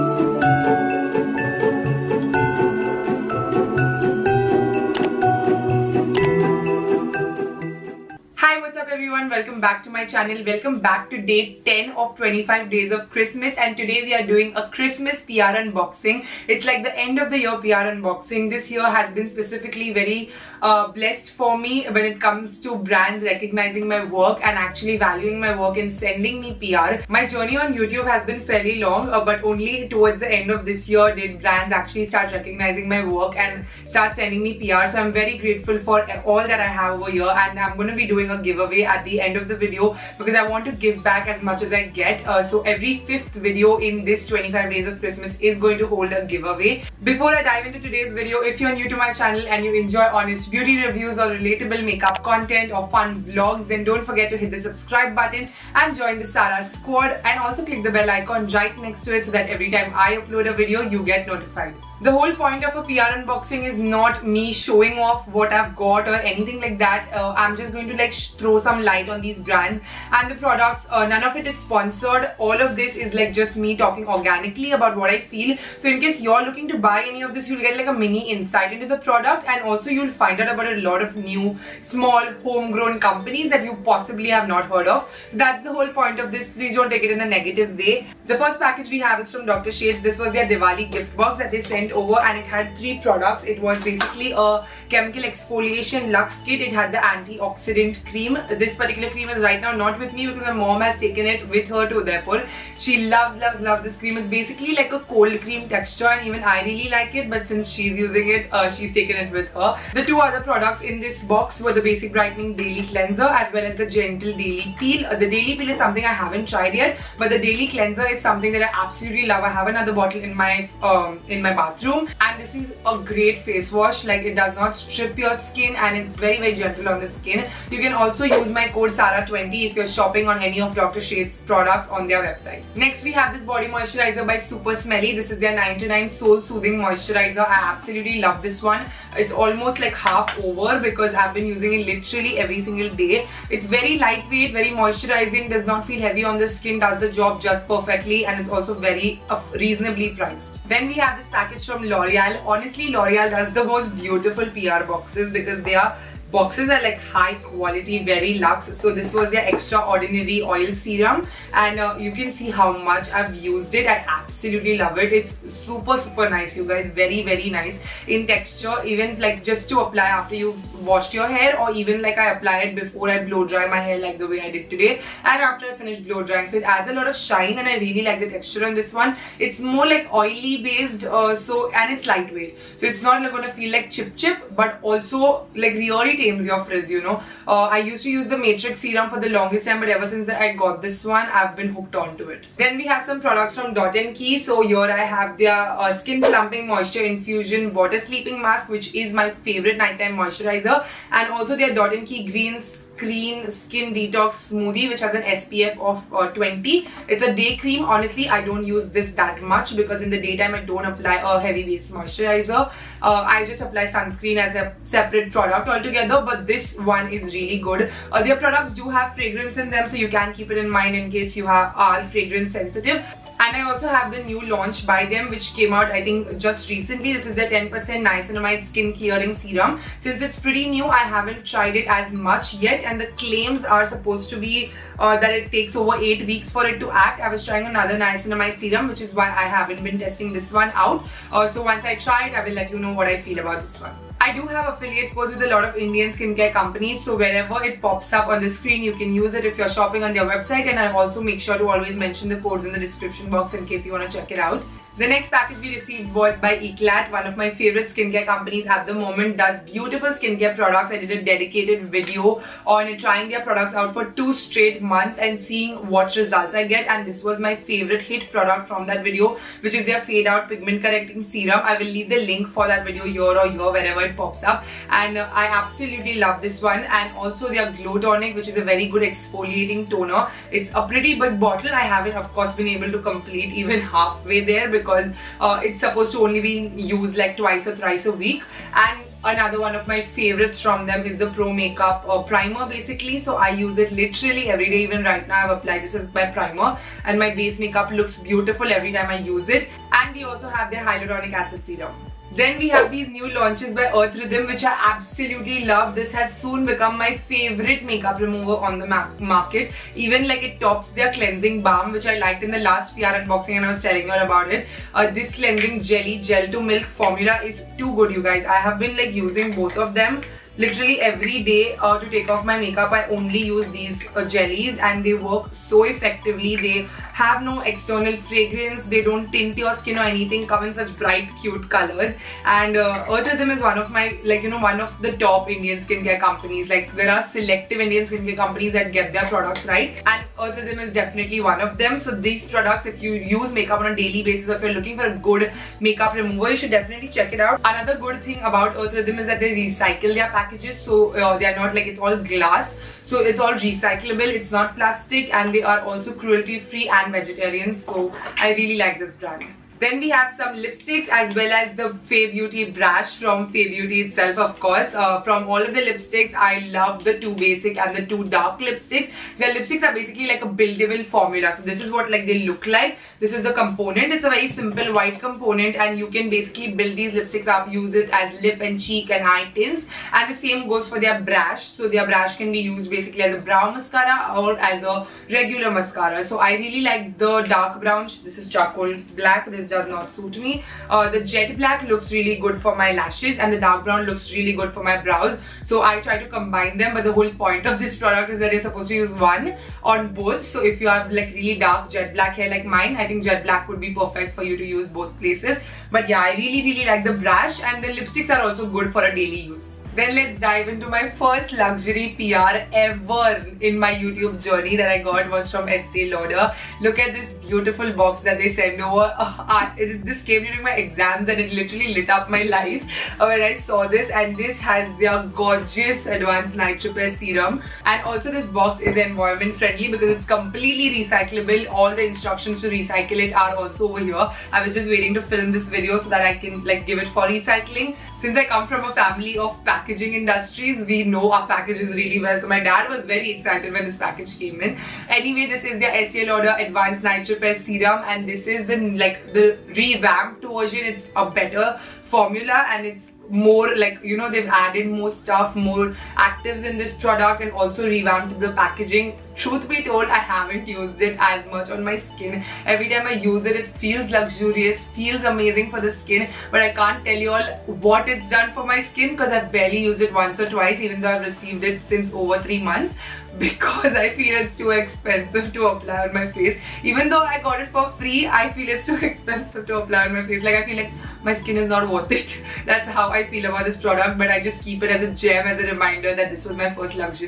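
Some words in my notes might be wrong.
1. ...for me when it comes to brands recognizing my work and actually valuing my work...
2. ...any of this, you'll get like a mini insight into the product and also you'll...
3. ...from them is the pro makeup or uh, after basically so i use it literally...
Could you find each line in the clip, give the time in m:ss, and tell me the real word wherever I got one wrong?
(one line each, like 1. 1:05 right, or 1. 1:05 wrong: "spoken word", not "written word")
1. 0:21 right
2. 1:17 right
3. 4:50 wrong: "primer", not "after".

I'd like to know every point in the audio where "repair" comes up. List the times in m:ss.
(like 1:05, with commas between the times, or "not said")
7:06, 7:27.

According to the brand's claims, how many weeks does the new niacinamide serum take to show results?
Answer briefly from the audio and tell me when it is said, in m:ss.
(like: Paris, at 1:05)
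8 weeks, at 3:56.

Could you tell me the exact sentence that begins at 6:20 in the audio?
And the same goes for their brush.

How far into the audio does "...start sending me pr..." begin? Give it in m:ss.
0:33.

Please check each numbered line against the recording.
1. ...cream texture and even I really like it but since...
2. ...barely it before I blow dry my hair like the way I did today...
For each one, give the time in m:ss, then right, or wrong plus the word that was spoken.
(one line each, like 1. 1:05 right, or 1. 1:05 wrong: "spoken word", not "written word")
1. 1:45 right
2. 2:52 wrong: "apply", not "barely".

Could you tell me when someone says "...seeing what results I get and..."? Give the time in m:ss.
4:25.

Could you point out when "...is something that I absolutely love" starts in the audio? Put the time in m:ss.
1:58.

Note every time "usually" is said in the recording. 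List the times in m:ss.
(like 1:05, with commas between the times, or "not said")
not said.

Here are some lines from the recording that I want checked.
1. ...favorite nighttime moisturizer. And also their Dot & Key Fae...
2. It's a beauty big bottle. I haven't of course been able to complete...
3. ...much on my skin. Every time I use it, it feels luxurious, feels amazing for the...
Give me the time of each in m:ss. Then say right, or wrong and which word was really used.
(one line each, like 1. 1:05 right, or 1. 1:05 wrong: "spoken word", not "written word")
1. 3:19 wrong: "Green", not "Fae"
2. 4:40 wrong: "pretty", not "beauty"
3. 7:41 right.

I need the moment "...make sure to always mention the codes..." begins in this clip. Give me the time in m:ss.
4:11.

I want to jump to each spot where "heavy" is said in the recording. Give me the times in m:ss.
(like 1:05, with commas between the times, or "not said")
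2:26, 3:31.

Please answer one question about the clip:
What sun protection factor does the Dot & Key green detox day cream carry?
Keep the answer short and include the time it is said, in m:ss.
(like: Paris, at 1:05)
20, at 3:26.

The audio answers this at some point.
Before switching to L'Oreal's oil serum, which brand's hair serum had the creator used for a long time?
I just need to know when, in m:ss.
3:08.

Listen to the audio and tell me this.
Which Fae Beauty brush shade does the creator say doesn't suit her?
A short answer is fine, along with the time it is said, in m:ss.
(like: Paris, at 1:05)
charcoal black, at 6:28.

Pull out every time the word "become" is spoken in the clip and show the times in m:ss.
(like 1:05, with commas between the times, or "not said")
5:06.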